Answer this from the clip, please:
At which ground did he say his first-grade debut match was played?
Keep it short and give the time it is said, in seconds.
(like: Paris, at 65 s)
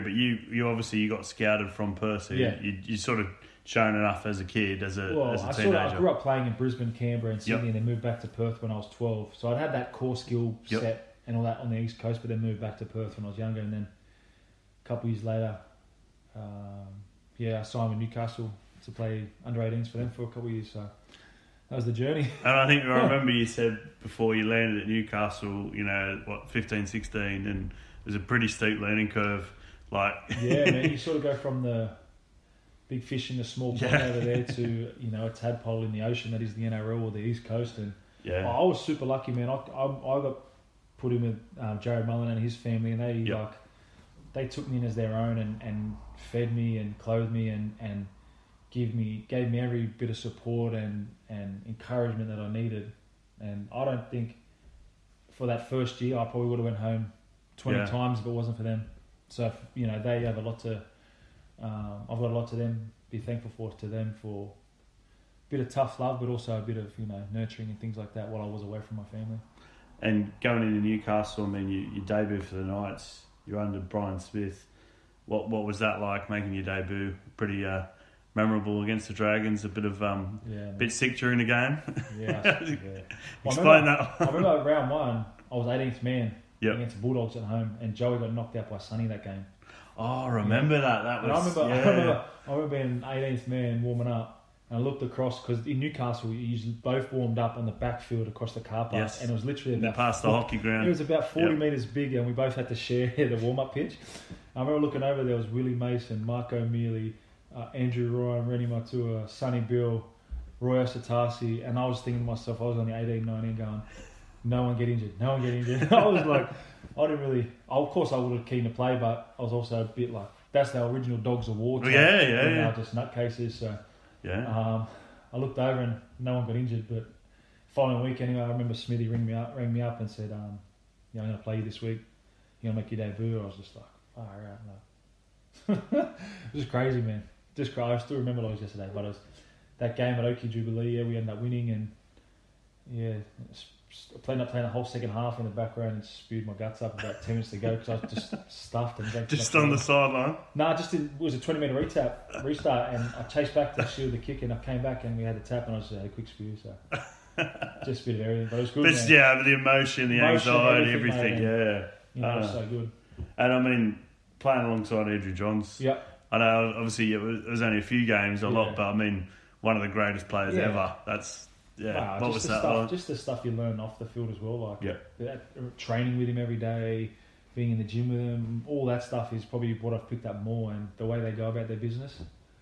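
Oki Jubilee, at 140 s.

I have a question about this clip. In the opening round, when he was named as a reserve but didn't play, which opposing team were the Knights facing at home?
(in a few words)
Bulldogs.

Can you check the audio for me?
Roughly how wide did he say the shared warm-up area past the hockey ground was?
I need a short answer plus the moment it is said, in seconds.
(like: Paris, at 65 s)
40 metres, at 101 s.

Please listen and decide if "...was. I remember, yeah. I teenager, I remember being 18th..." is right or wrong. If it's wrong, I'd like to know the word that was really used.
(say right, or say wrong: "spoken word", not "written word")
wrong: "remember", not "teenager".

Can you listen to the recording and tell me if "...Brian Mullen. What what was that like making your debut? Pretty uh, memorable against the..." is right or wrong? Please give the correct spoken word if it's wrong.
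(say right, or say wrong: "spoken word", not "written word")
wrong: "Smith", not "Mullen".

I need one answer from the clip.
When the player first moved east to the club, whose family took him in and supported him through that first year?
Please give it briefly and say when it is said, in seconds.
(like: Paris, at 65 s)
Jarrod Mullen, at 41 s.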